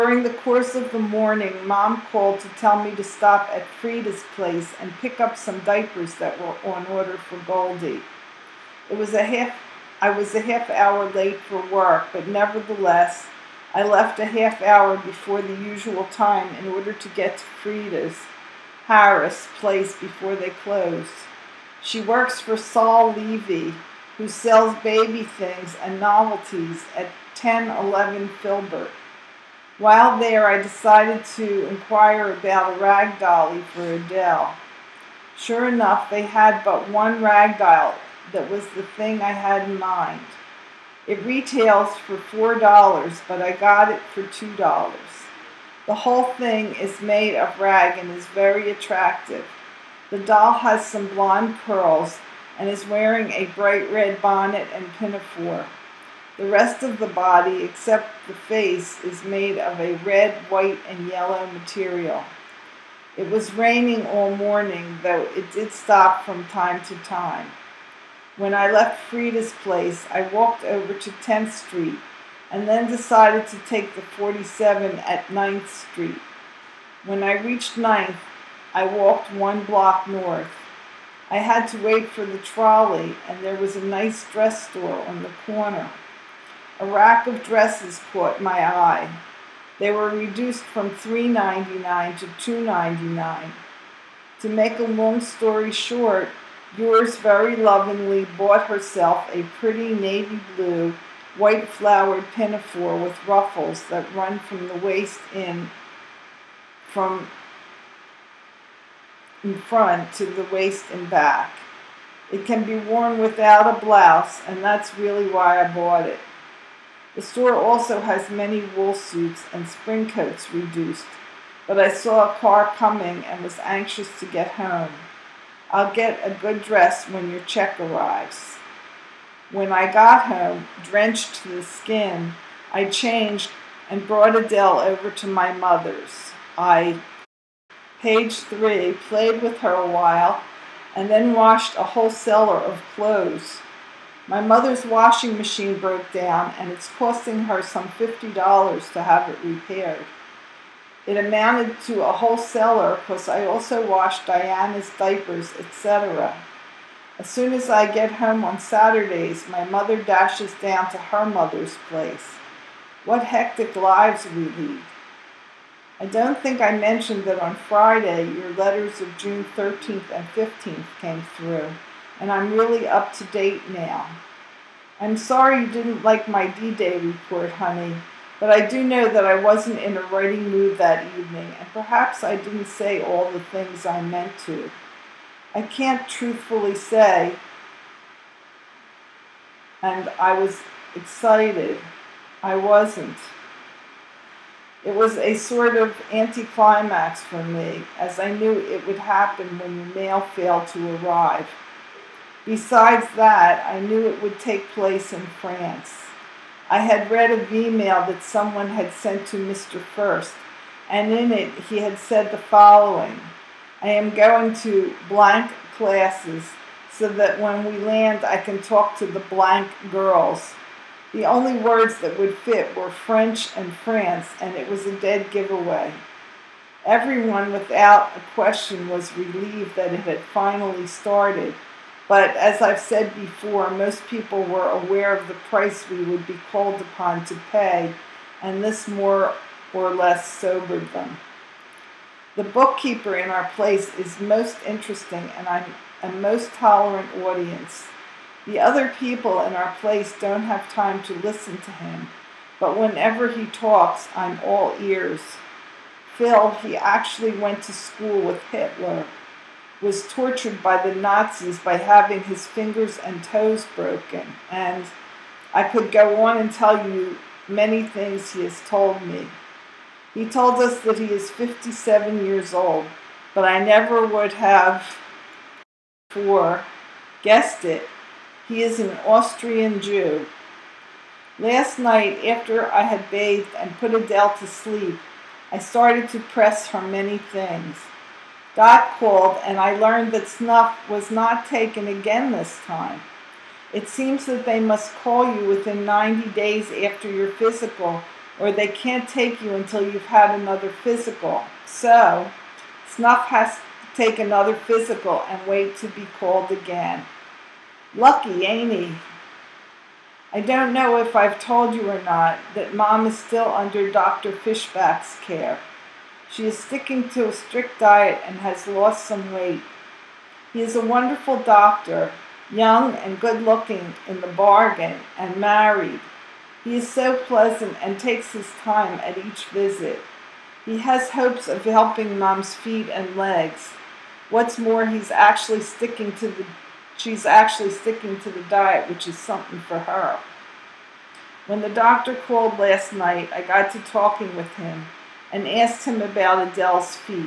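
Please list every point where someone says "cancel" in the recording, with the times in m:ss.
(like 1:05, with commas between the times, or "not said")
not said.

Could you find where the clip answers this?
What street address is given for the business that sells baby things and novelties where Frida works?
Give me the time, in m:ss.
0:27.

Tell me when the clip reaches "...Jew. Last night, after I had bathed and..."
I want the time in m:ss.
4:39.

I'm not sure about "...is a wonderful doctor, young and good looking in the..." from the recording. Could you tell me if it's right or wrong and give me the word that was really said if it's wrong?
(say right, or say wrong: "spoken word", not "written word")
right.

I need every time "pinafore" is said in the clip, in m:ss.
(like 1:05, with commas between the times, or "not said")
0:54, 1:42.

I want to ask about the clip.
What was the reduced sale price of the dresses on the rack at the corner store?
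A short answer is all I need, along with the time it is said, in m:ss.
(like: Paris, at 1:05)
$2.99, at 1:32.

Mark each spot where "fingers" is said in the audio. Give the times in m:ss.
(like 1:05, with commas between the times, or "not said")
4:22.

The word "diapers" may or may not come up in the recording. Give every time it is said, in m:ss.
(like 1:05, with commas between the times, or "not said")
0:05, 2:34.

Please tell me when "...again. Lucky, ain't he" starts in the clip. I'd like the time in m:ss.
5:06.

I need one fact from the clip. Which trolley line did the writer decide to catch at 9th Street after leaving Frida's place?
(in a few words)
47.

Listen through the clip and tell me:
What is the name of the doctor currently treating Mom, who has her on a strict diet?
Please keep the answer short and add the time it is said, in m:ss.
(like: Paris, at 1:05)
Dr. Fishback, at 5:13.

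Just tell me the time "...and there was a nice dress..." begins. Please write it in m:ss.
1:23.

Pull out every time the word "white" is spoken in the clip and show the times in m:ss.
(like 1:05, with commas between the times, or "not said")
1:00, 1:41.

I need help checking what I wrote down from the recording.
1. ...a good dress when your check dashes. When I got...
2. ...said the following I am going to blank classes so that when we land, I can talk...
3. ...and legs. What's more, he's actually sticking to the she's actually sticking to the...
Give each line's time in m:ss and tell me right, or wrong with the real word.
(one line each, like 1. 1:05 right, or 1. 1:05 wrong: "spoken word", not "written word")
1. 2:06 wrong: "arrives", not "dashes"
2. 3:31 right
3. 5:32 right.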